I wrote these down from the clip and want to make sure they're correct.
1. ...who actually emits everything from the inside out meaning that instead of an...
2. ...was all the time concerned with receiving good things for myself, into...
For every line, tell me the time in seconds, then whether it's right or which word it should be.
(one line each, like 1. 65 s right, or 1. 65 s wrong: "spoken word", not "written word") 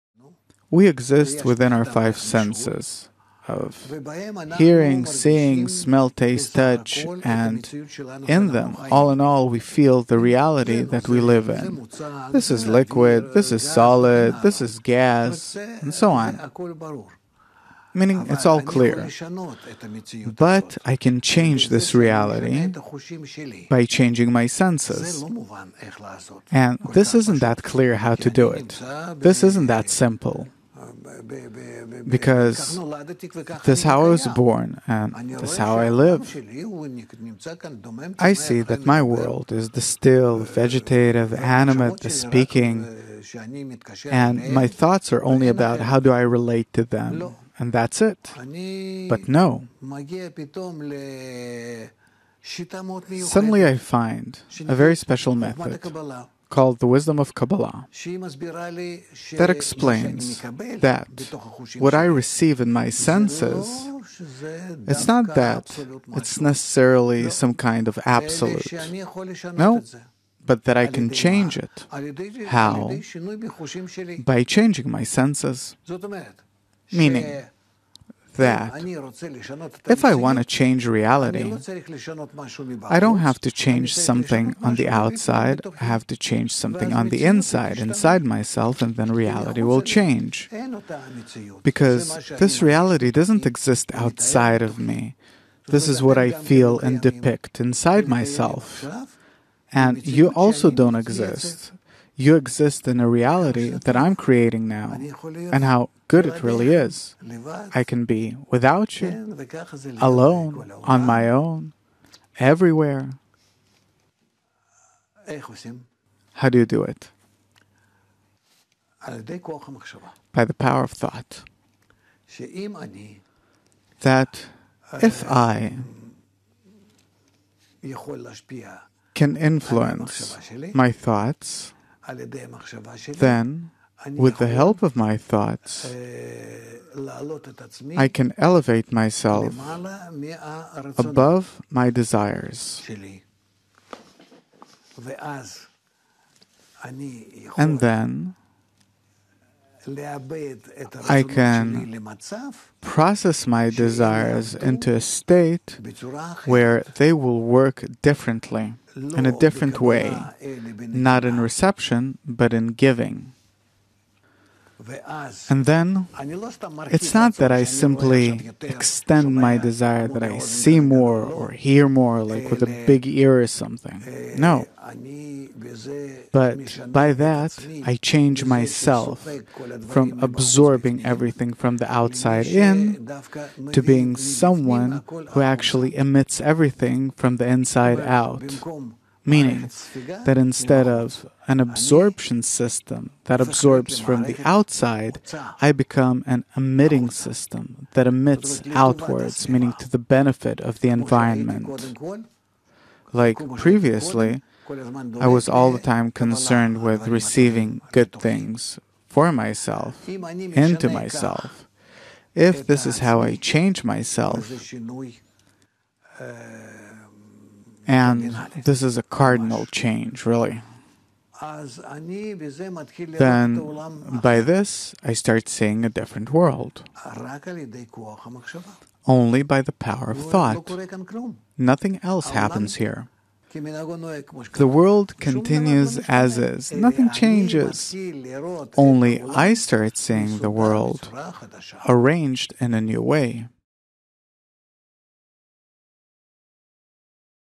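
1. 185 s right
2. 205 s right.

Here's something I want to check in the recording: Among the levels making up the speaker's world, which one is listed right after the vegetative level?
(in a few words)
Animate.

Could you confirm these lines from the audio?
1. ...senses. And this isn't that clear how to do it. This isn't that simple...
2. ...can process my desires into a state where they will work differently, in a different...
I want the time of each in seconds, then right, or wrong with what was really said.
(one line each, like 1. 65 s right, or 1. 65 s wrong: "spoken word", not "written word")
1. 24 s right
2. 151 s right.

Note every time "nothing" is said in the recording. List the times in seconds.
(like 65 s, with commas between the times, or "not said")
231 s, 236 s.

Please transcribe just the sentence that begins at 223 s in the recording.
Then, by this, I start seeing a different world.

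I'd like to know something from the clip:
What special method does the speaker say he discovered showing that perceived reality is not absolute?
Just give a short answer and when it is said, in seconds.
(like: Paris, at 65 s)
The Wisdom of Kabbalah, at 56 s.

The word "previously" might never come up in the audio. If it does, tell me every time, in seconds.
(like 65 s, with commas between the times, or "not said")
203 s.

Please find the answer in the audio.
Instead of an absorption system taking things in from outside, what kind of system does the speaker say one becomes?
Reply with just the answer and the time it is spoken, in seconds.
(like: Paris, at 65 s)
An emitting system, at 196 s.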